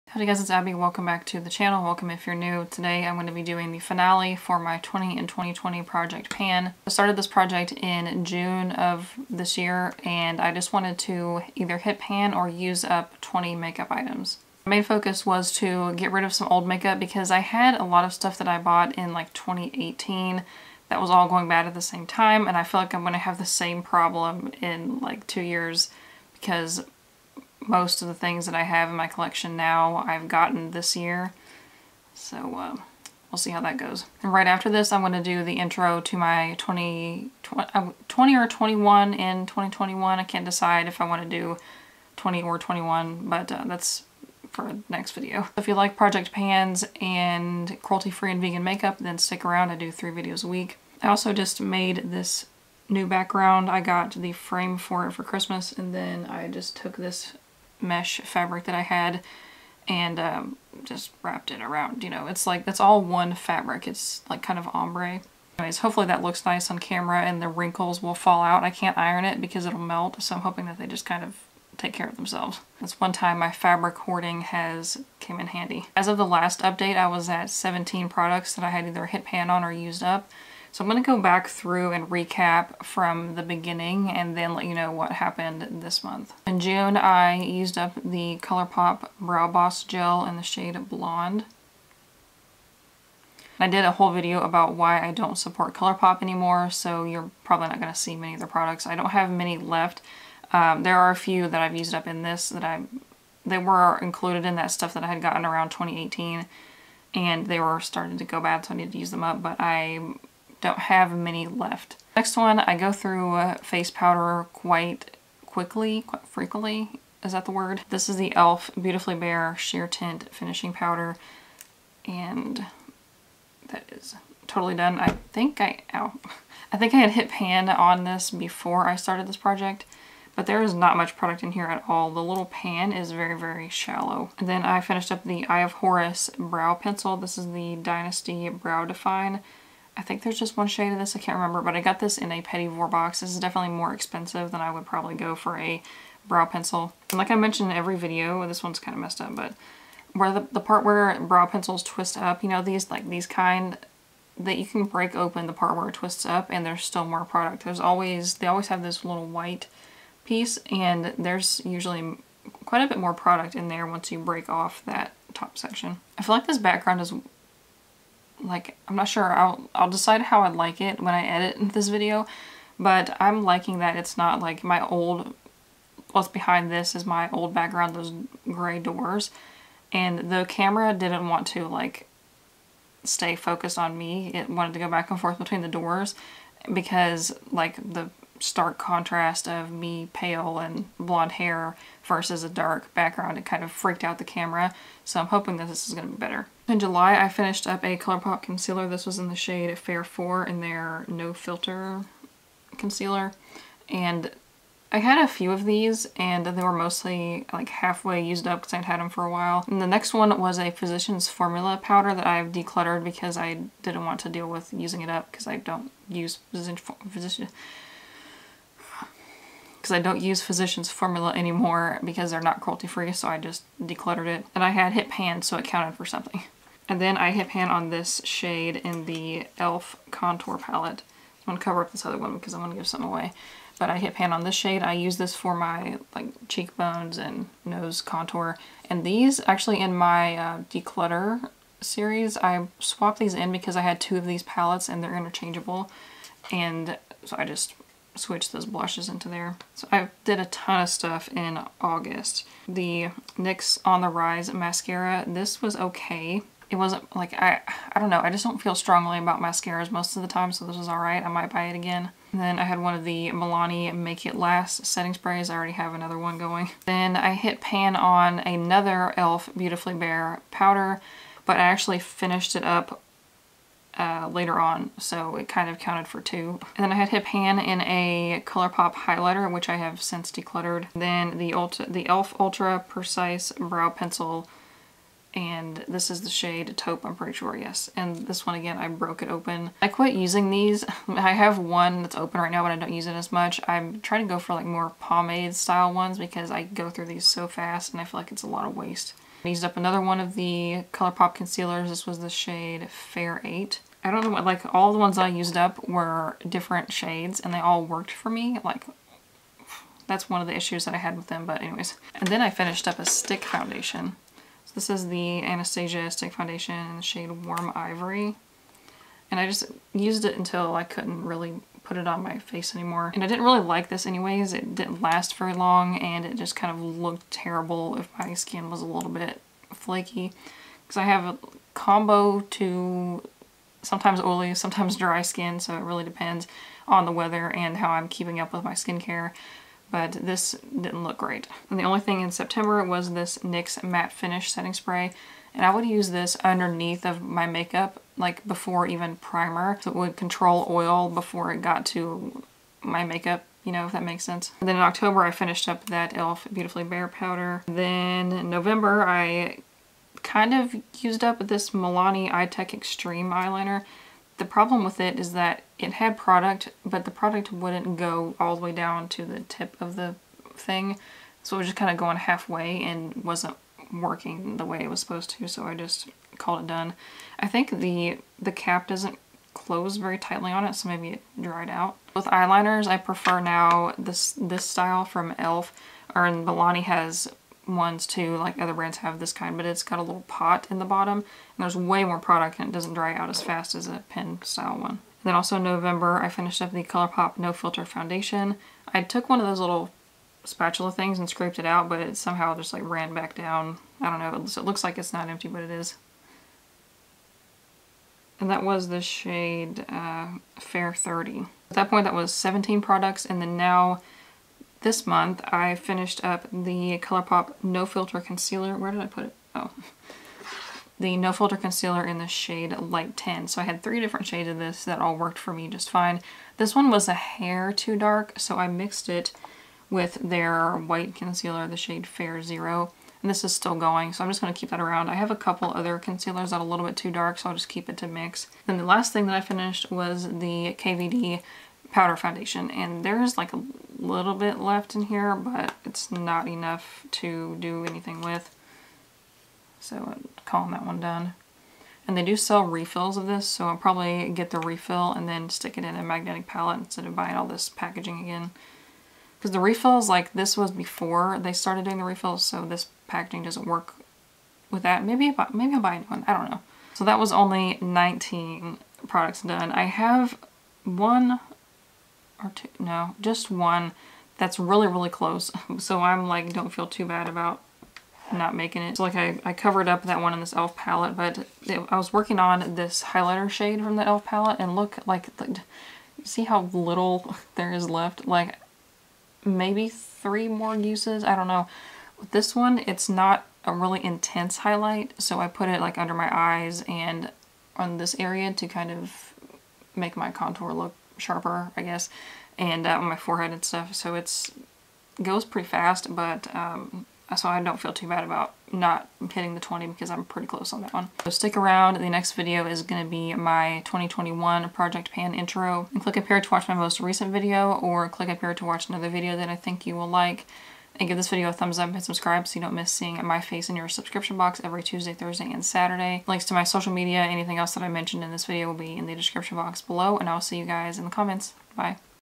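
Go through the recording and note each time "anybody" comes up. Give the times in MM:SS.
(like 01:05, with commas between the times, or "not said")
not said.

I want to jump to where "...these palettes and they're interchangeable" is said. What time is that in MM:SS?
04:04.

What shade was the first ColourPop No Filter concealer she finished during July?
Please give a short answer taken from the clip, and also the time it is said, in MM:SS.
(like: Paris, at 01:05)
Fair 4, at 03:19.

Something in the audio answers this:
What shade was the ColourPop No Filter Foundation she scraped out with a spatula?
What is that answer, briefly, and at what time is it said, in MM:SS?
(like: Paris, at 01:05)
Fair 30, at 06:50.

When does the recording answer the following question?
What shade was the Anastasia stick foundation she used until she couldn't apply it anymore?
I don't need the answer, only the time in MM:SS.
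05:17.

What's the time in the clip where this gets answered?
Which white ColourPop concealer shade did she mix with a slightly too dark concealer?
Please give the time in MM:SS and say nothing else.
07:12.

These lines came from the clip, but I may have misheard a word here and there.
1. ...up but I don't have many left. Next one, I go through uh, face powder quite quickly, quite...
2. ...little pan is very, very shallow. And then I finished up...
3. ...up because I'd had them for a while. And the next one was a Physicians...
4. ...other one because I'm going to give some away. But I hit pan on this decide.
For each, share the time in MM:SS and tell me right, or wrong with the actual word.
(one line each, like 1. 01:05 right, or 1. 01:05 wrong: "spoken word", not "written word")
1. 01:49 right
2. 02:12 right
3. 03:28 right
4. 03:52 wrong: "shade", not "decide".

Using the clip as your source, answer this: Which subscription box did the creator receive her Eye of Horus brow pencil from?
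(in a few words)
Petit Vour.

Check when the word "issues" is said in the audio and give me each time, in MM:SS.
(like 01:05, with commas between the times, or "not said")
05:10.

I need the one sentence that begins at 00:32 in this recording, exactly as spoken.
So uh, we'll see how that goes.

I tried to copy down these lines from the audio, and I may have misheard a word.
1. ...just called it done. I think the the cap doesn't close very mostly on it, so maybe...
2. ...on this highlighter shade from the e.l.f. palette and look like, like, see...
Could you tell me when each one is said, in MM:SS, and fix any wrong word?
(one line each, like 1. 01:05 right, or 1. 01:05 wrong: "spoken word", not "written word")
1. 06:15 wrong: "tightly", not "mostly"
2. 08:02 right.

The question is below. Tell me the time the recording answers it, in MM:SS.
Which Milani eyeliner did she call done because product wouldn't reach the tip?
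06:02.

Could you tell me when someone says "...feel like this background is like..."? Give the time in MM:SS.
02:46.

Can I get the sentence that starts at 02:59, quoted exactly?
And the camera didn't want to like stay focused on me.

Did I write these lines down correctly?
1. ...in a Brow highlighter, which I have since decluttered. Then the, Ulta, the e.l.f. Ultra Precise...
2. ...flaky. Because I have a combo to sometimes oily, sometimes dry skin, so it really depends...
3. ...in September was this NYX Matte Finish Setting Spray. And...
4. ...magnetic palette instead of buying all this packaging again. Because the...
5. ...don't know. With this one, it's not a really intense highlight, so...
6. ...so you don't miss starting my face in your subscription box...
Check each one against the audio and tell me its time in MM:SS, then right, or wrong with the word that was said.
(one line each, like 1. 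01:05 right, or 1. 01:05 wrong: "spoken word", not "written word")
1. 04:37 wrong: "ColourPop", not "Brow"
2. 05:29 right
3. 05:42 right
4. 07:36 right
5. 08:11 right
6. 08:42 wrong: "seeing", not "starting".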